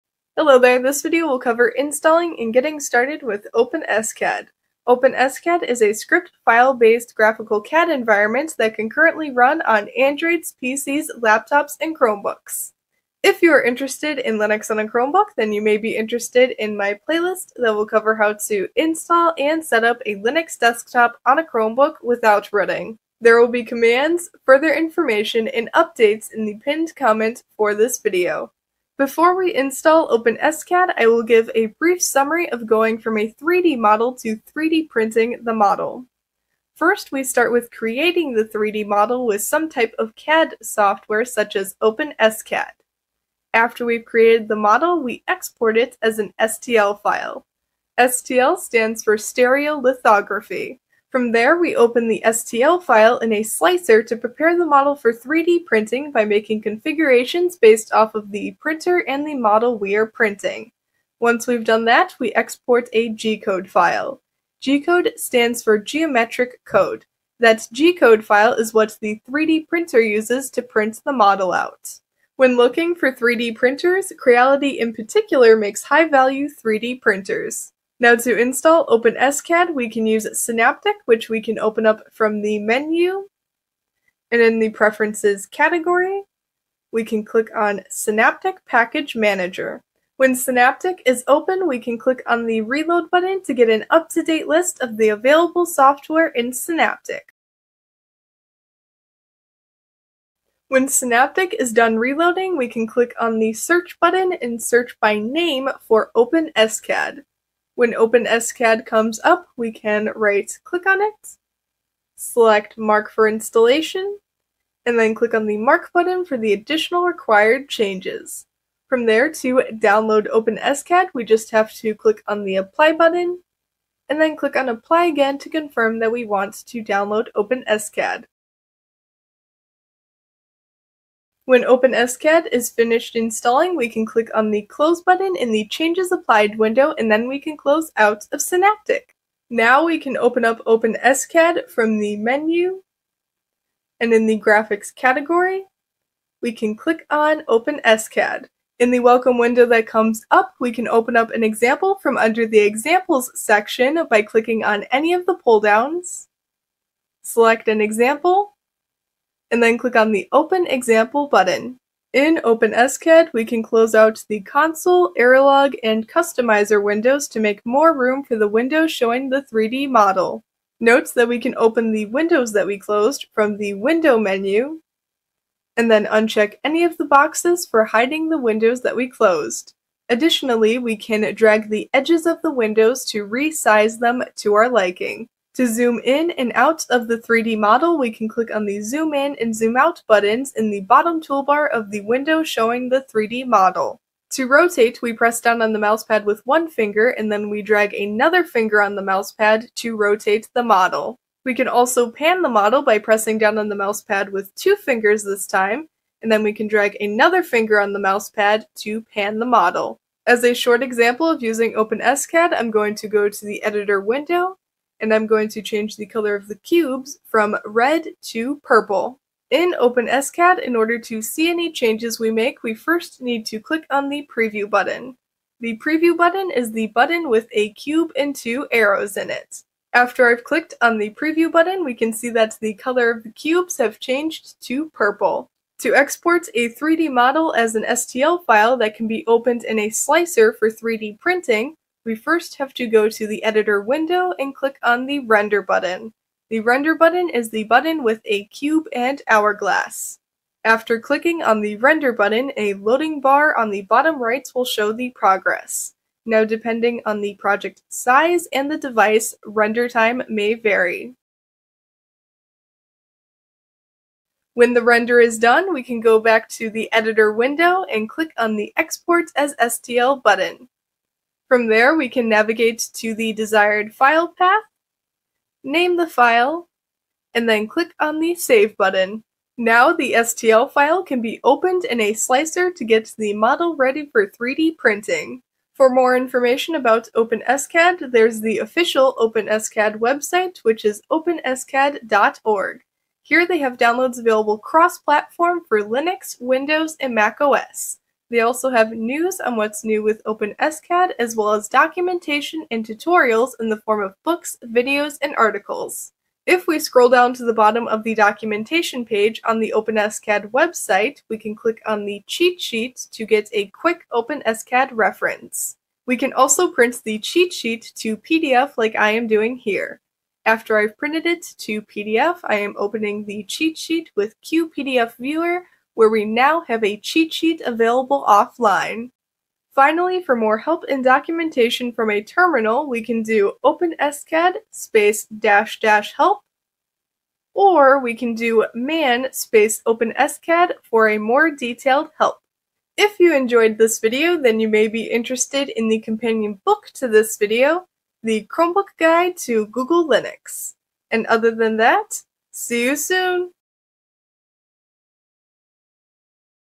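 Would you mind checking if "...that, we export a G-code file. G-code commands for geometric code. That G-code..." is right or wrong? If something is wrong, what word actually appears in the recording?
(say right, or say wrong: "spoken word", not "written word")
wrong: "stands", not "commands".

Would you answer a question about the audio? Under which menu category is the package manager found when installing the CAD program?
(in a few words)
Preferences.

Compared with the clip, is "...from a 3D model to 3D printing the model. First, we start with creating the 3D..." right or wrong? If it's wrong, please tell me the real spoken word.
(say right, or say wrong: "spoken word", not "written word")
right.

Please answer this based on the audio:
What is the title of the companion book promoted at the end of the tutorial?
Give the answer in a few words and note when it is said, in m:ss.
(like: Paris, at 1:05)
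The Chromebook Guide to Google Linux, at 5:48.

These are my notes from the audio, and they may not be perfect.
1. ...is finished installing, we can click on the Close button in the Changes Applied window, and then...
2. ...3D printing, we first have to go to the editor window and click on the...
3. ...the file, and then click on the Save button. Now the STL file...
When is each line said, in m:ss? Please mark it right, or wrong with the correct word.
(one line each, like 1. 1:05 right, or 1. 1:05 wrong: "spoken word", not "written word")
1. 2:12 right
2. 4:00 right
3. 4:35 right.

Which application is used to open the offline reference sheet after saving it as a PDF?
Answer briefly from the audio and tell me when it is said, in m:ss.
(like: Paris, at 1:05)
QPDF Viewer, at 5:24.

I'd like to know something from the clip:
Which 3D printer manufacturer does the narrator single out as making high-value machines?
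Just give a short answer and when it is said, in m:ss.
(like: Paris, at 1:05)
Creality, at 1:14.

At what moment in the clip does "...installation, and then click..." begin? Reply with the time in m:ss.
1:53.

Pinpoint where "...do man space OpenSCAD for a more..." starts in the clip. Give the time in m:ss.
5:38.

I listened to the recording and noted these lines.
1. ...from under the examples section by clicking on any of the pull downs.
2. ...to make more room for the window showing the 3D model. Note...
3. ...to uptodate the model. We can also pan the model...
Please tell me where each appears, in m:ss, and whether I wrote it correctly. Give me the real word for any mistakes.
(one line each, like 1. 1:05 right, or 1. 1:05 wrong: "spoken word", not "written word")
1. 2:31 right
2. 2:47 right
3. 3:19 wrong: "rotate", not "uptodate".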